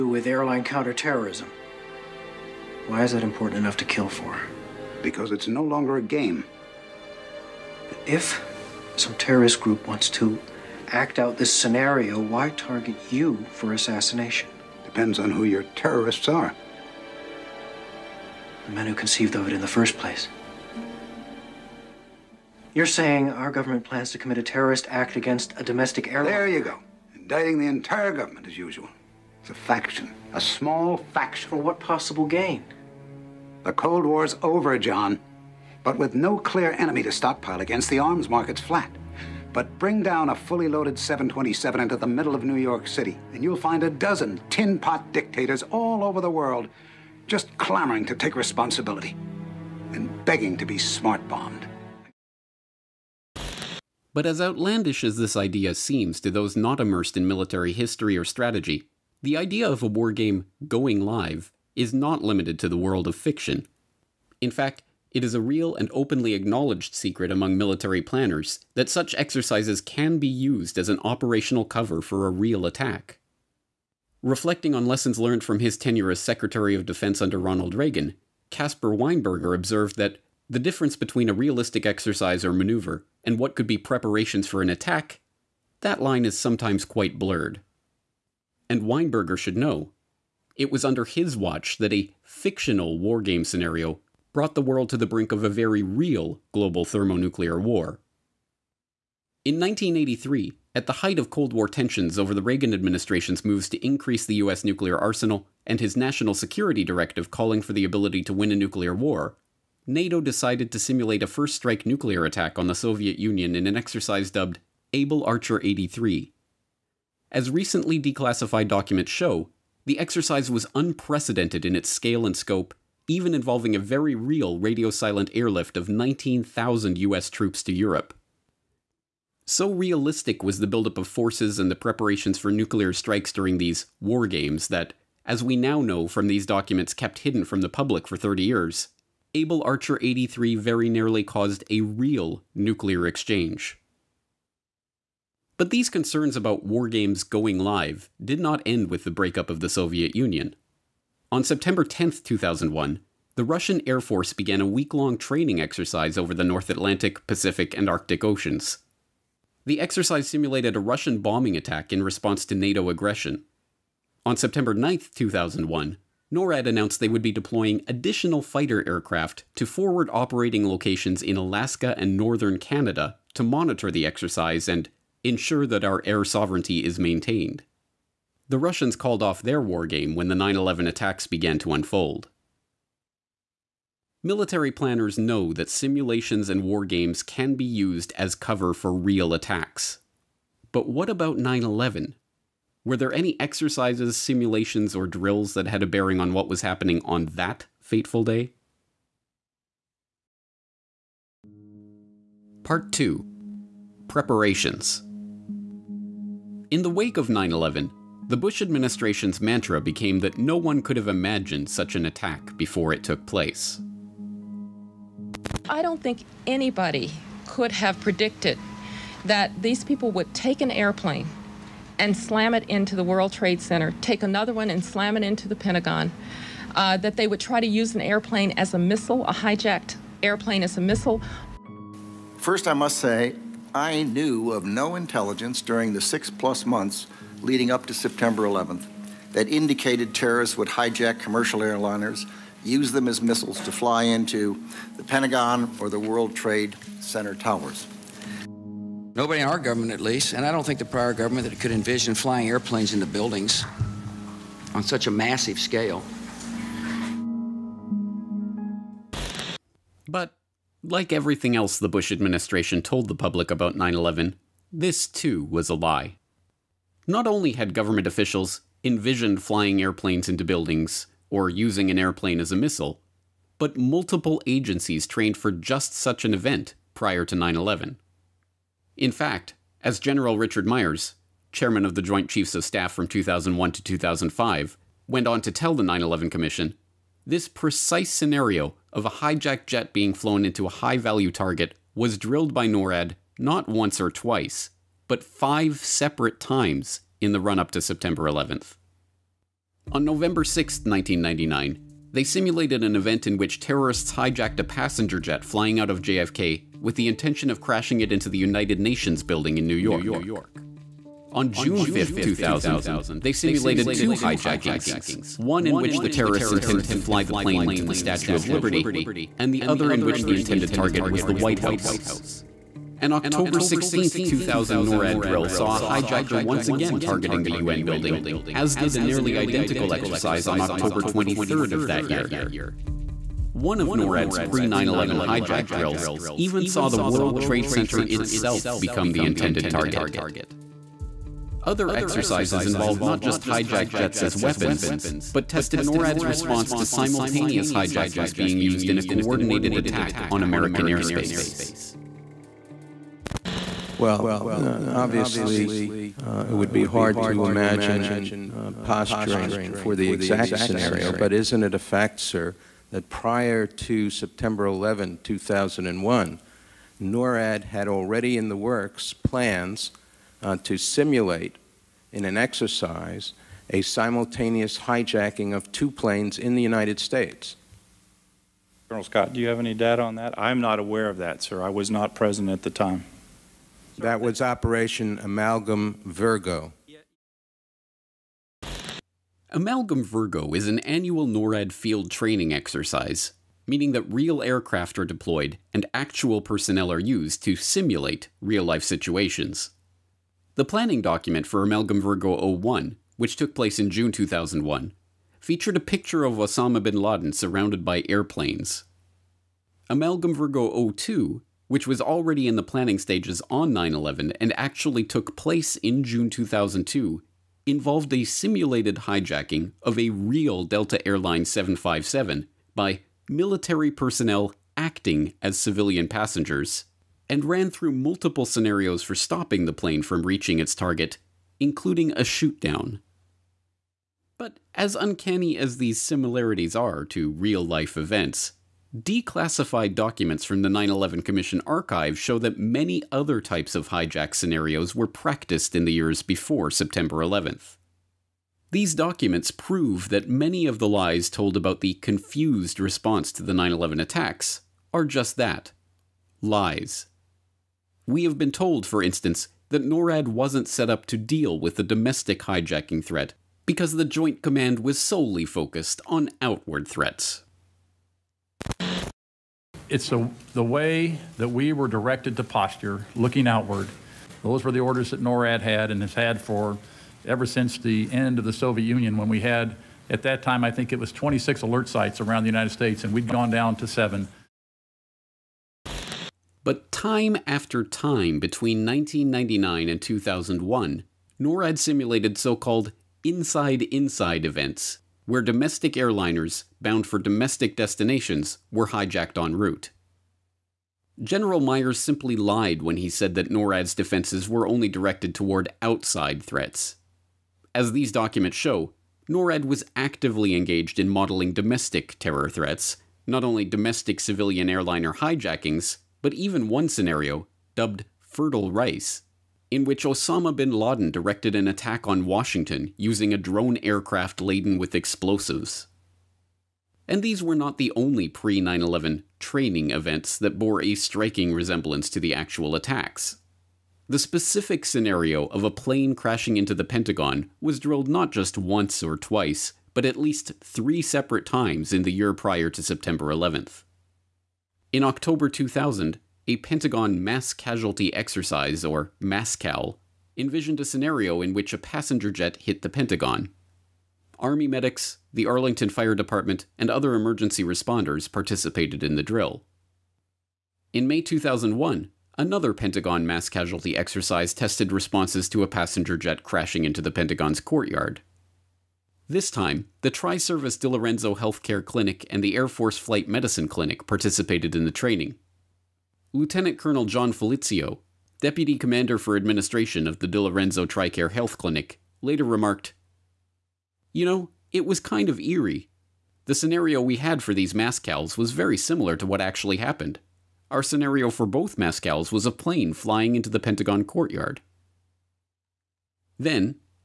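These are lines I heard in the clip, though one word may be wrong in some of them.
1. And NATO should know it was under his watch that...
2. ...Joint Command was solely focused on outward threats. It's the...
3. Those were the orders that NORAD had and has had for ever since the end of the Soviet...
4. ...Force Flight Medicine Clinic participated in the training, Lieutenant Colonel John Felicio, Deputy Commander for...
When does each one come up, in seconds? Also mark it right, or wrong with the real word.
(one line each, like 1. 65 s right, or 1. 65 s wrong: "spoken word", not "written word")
1. 88 s wrong: "Weinberger", not "NATO"
2. 464 s right
3. 474 s right
4. 572 s right.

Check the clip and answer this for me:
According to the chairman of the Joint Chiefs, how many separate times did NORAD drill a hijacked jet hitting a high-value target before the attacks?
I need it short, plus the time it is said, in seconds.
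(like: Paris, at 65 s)
5, at 295 s.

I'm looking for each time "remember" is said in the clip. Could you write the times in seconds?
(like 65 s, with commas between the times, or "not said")
not said.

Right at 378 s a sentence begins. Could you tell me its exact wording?
Colonel Scott, do you have any data on that?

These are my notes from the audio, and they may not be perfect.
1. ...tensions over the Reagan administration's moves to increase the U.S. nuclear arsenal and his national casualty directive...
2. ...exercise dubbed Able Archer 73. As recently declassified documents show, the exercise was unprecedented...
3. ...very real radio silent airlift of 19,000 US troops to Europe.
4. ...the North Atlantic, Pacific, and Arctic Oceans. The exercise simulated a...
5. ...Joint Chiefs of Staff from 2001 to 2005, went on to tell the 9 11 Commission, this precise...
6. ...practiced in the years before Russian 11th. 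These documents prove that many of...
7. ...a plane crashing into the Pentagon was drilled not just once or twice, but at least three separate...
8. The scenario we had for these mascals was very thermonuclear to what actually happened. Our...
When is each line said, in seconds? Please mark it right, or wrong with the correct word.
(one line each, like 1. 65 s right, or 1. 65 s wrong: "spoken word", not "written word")
1. 101 s wrong: "security", not "casualty"
2. 113 s wrong: "83", not "73"
3. 123 s right
4. 156 s right
5. 282 s right
6. 445 s wrong: "September", not "Russian"
7. 535 s right
8. 586 s wrong: "similar", not "thermonuclear".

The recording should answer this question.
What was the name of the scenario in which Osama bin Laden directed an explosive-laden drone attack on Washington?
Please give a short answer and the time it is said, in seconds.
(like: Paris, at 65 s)
Fertile Rice, at 518 s.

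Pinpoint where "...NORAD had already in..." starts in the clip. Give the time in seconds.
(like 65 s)
367 s.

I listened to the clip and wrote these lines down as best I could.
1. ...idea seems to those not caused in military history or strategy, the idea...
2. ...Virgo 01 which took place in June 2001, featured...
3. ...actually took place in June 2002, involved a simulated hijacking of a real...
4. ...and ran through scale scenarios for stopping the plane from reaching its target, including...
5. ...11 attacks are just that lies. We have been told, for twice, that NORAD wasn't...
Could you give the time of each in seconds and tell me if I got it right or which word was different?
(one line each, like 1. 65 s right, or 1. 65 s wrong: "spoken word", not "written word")
1. 55 s wrong: "immersed", not "caused"
2. 402 s right
3. 414 s right
4. 427 s wrong: "multiple", not "scale"
5. 453 s wrong: "instance", not "twice".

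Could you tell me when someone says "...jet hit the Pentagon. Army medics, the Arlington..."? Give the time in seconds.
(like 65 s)
552 s.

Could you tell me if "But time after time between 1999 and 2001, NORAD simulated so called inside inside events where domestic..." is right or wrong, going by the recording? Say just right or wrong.
right.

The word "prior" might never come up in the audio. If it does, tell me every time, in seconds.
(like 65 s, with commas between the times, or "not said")
250 s, 276 s, 363 s, 542 s.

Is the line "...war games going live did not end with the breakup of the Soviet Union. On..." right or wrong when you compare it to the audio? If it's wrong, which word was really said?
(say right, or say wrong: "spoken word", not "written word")
right.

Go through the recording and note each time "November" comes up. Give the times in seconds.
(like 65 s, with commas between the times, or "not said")
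300 s.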